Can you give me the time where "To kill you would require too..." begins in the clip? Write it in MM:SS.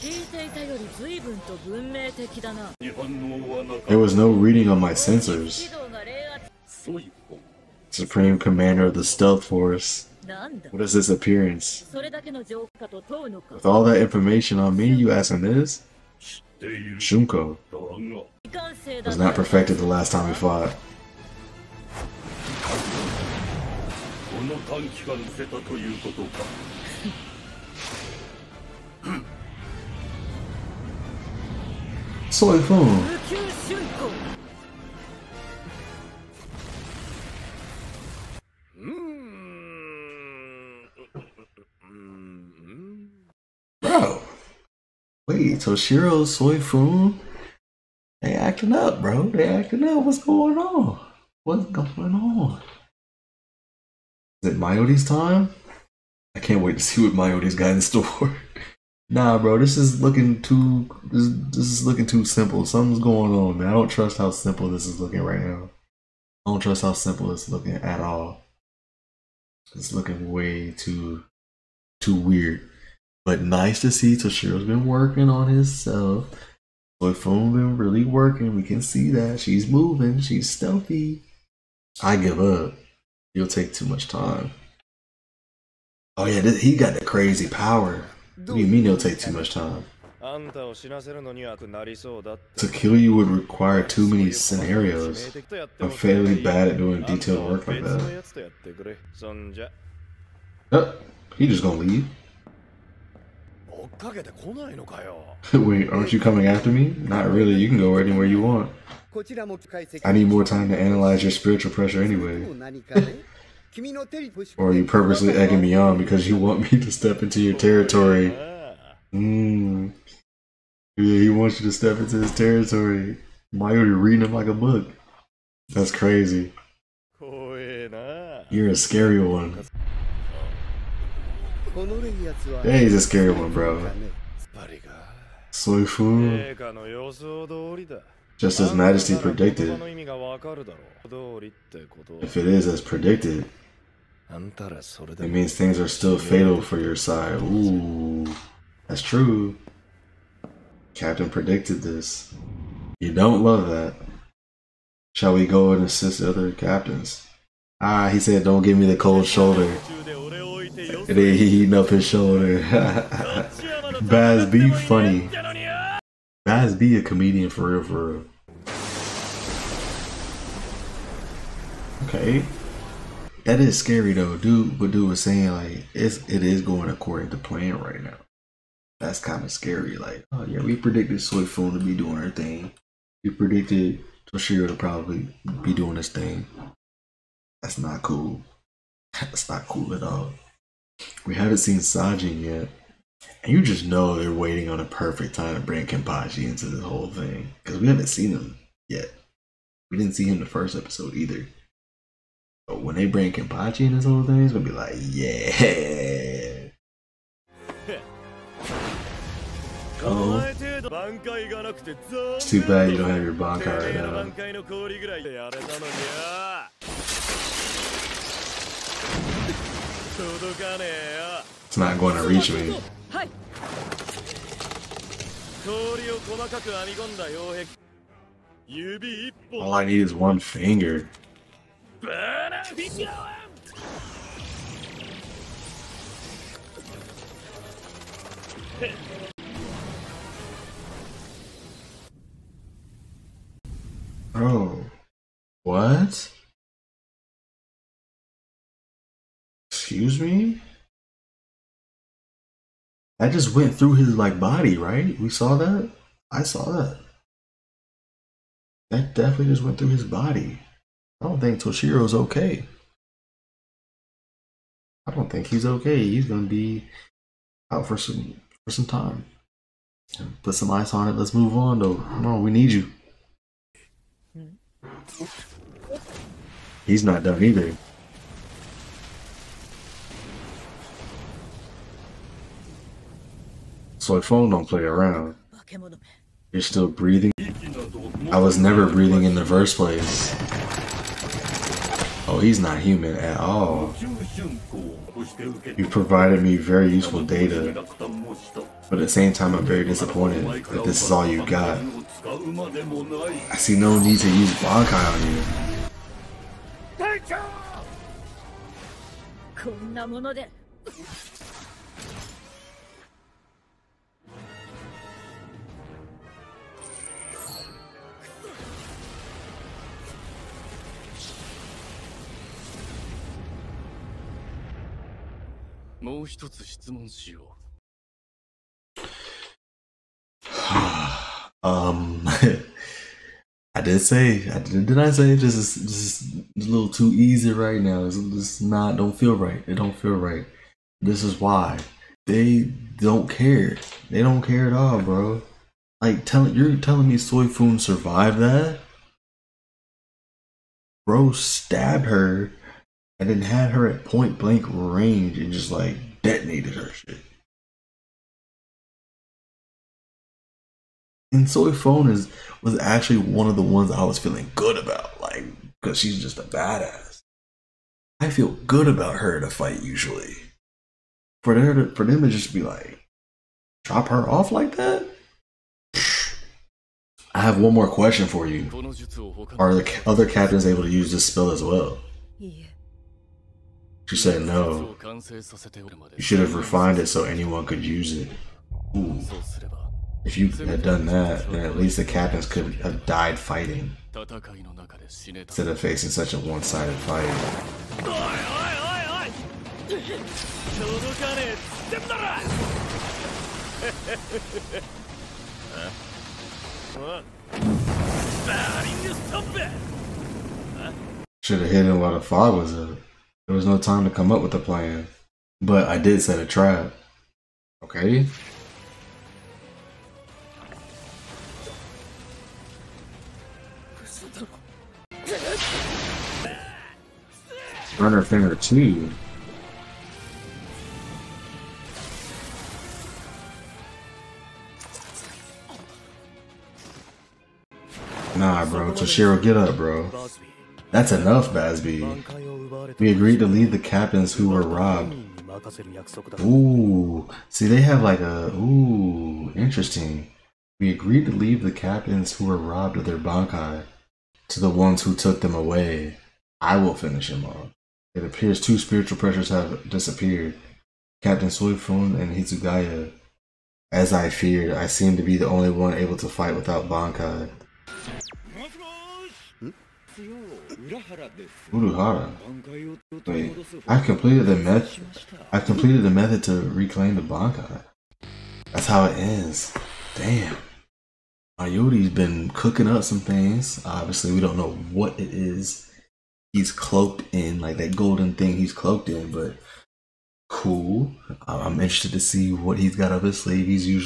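01:30.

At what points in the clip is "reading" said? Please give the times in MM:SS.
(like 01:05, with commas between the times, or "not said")
00:04, 02:04.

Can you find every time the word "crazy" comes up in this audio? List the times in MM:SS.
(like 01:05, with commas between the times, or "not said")
01:27, 02:05.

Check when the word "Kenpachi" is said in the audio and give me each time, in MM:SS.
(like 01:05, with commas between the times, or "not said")
03:15, 03:23.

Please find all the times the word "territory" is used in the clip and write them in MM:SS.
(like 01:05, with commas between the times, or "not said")
01:57, 02:02.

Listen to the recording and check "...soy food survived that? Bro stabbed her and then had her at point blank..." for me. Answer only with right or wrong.
right.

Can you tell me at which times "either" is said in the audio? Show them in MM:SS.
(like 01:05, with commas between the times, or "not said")
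03:21, 04:37.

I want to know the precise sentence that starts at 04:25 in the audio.
He's gonna be out for some for some time.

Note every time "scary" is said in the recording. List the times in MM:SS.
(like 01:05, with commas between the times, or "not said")
02:08, 02:13, 02:53, 02:59.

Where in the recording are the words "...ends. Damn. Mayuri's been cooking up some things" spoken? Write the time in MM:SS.
07:59.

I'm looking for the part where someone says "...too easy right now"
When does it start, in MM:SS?
05:36.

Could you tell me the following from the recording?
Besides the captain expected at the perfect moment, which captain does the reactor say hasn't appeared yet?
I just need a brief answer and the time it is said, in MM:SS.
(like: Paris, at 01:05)
Sajin, at 03:11.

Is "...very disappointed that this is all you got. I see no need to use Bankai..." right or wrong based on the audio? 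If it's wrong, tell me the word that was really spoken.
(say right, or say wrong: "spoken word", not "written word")
right.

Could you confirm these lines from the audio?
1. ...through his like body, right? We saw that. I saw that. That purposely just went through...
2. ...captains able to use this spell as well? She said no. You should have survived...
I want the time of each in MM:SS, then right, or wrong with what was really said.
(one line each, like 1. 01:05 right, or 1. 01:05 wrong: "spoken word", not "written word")
1. 04:13 wrong: "definitely", not "purposely"
2. 06:20 wrong: "refined", not "survived".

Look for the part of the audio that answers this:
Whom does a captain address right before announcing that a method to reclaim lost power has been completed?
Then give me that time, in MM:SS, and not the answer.
07:50.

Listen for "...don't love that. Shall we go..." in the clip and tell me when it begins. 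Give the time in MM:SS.
02:33.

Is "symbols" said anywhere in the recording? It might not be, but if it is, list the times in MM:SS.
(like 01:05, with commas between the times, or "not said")
not said.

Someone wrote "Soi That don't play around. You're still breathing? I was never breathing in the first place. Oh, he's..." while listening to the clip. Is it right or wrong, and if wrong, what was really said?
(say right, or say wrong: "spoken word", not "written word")
wrong: "Fon", not "That".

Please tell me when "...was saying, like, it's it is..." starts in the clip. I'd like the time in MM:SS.
02:55.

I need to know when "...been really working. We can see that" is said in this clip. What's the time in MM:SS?
01:17.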